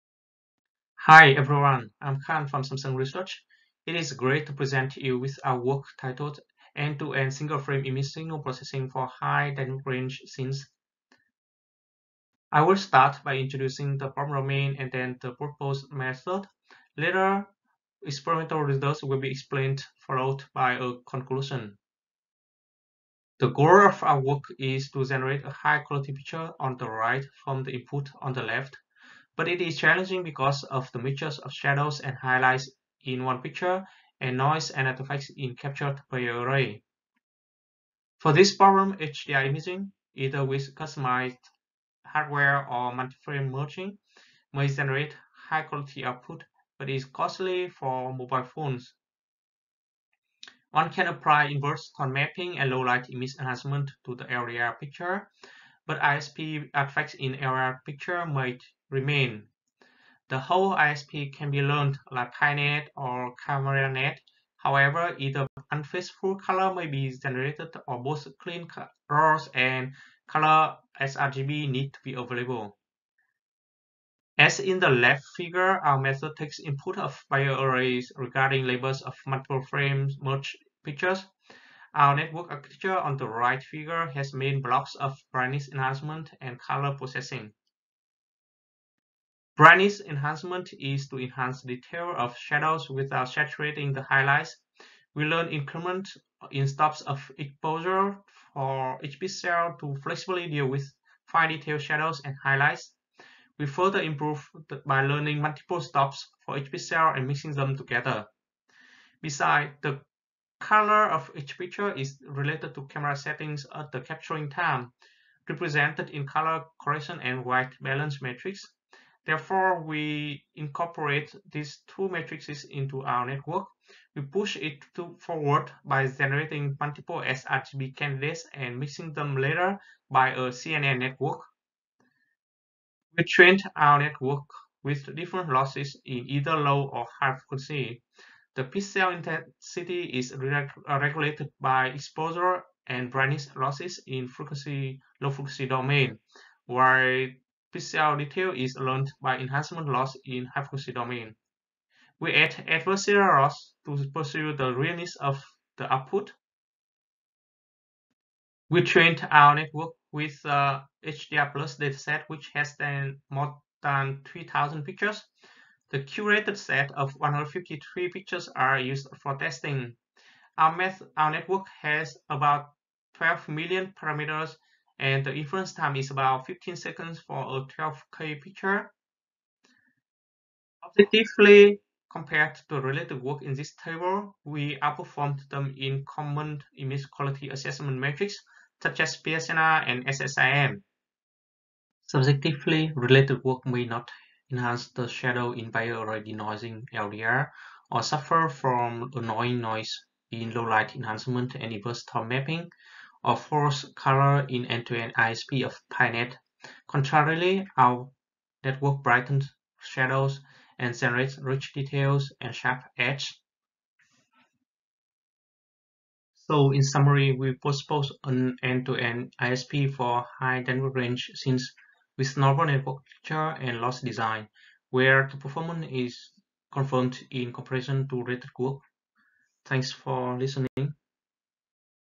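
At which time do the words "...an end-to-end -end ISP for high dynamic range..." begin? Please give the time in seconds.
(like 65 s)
218 s.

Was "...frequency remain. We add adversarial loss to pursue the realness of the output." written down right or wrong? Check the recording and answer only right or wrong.
wrong.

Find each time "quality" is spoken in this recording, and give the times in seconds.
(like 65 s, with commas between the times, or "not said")
25 s, 45 s, 187 s.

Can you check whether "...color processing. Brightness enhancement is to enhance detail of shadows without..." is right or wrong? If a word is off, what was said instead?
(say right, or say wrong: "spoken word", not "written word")
right.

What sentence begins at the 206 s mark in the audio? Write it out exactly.
Contrarily, our network brightens shadows and generates rich details and sharp edge.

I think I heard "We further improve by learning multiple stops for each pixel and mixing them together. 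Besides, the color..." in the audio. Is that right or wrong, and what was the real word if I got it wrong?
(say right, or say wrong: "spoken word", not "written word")
right.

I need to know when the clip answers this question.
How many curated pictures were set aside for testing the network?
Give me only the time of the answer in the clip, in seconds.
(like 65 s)
167 s.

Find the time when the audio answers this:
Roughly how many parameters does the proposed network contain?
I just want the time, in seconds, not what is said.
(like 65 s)
173 s.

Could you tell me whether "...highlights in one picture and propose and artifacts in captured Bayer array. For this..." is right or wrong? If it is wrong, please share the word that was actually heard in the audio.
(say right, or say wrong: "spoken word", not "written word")
wrong: "noise", not "propose".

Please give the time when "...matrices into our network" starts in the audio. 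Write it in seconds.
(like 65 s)
122 s.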